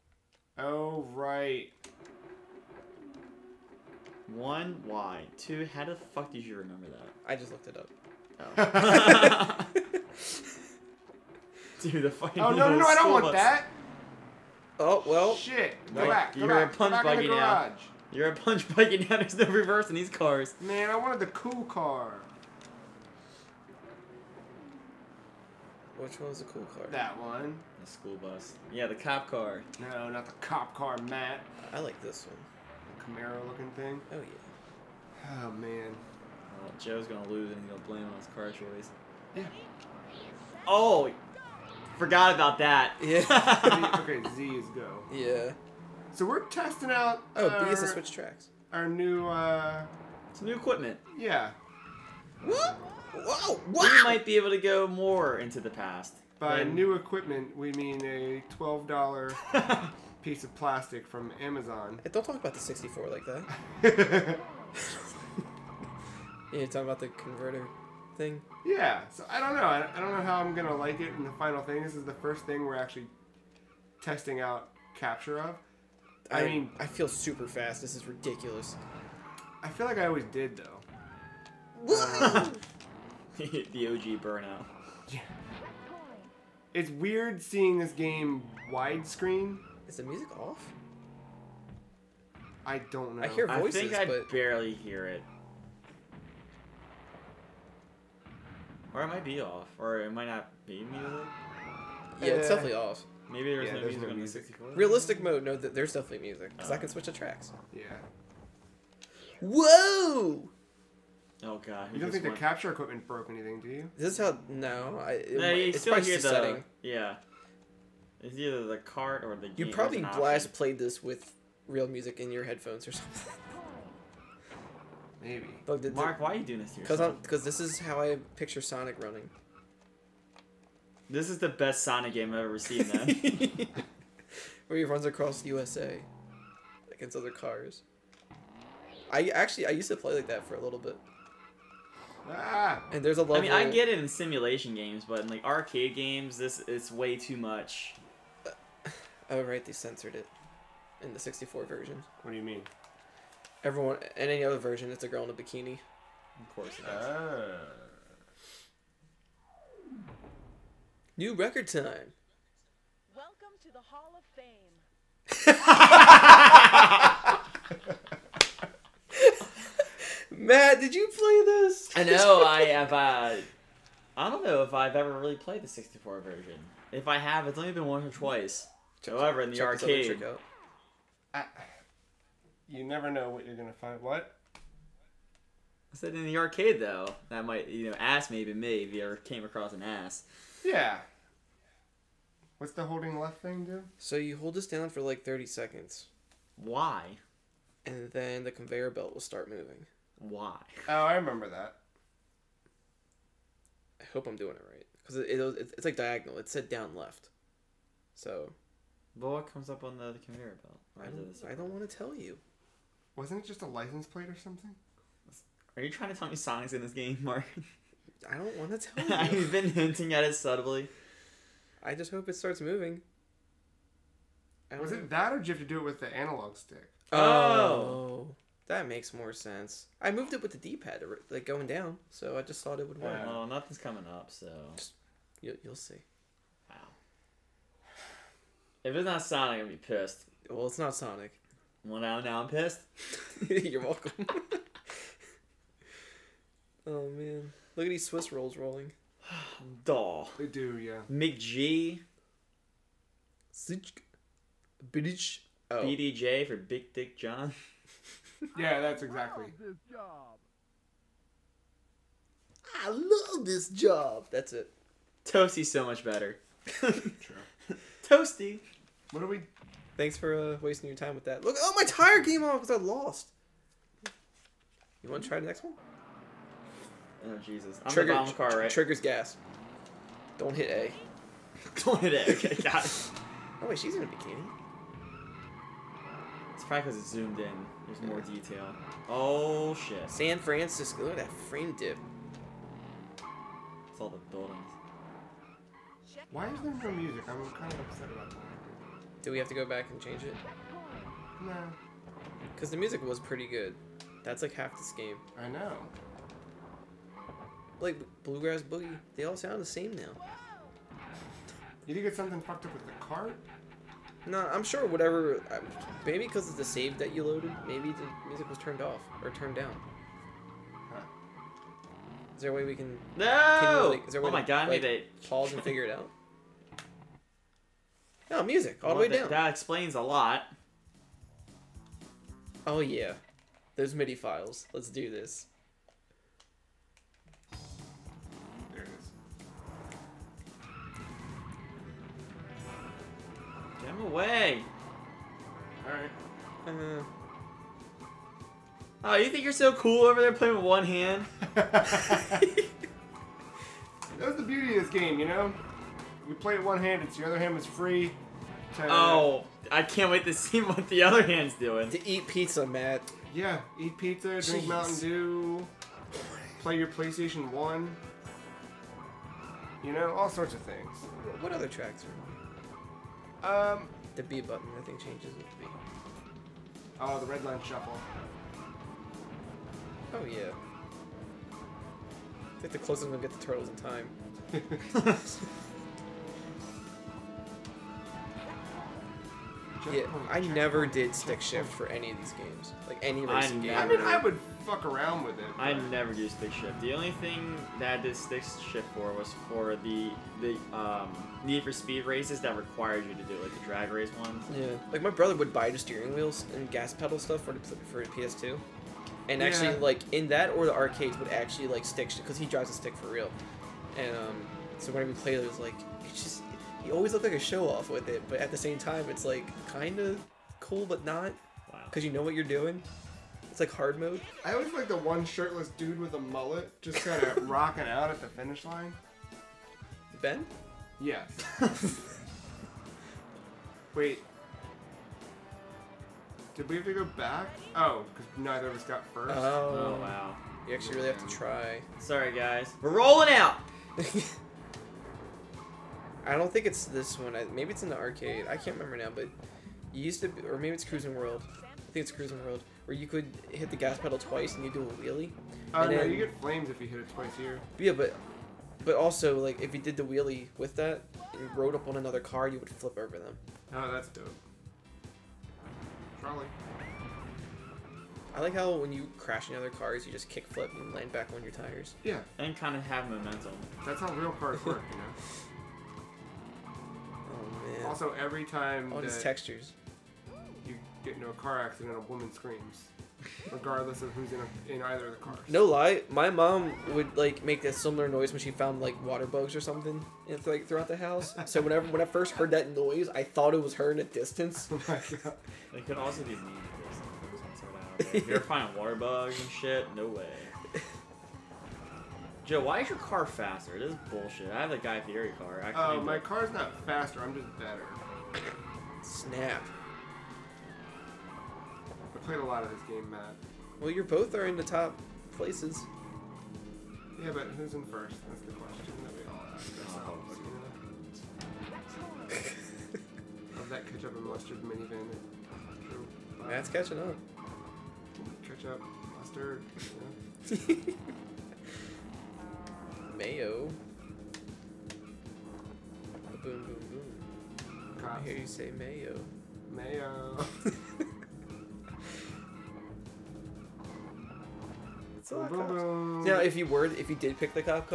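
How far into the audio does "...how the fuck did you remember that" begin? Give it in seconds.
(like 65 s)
5 s.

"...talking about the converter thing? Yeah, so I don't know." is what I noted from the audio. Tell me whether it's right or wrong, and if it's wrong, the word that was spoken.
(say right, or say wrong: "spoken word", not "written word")
right.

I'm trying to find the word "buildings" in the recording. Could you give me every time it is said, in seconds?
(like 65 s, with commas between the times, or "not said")
294 s.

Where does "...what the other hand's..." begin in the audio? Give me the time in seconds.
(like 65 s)
360 s.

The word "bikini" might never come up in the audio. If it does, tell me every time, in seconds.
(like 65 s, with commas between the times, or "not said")
155 s, 284 s.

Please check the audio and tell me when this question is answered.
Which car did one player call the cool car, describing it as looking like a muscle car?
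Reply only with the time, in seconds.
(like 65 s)
33 s.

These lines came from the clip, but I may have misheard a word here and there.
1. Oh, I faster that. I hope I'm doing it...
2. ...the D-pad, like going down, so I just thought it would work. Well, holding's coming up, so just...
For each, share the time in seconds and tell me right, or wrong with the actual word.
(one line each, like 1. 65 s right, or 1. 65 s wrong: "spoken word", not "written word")
1. 200 s wrong: "remember", not "faster"
2. 230 s wrong: "nothing", not "holding".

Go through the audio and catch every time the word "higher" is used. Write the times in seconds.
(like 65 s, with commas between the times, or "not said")
not said.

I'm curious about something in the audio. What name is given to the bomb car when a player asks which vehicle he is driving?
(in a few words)
Trigger.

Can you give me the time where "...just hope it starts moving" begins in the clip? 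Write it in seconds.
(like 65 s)
221 s.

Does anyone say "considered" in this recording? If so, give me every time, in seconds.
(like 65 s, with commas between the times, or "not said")
not said.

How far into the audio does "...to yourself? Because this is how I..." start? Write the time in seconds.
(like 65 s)
126 s.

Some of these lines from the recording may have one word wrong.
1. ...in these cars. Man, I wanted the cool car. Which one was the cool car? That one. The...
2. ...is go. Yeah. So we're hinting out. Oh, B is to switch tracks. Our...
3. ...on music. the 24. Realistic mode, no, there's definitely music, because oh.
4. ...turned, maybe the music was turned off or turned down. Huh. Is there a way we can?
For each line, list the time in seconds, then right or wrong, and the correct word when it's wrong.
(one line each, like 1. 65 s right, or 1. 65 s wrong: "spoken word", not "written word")
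1. 19 s right
2. 44 s wrong: "testing", not "hinting"
3. 104 s wrong: "64", not "24"
4. 317 s wrong: "loaded", not "turned".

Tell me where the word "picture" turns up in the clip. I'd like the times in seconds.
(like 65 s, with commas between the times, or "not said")
128 s.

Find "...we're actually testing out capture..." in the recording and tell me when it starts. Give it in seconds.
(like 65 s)
72 s.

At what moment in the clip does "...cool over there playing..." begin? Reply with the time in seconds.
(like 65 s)
349 s.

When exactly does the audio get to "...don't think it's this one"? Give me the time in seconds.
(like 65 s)
446 s.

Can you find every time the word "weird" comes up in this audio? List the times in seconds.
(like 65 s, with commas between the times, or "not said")
86 s.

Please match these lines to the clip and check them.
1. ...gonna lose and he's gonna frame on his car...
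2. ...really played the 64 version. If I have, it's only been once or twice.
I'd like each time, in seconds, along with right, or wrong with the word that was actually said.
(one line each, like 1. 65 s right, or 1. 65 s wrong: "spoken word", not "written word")
1. 37 s wrong: "blame", not "frame"
2. 175 s right.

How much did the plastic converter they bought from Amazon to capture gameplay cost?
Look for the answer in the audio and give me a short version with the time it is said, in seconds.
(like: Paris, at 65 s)
$12, at 58 s.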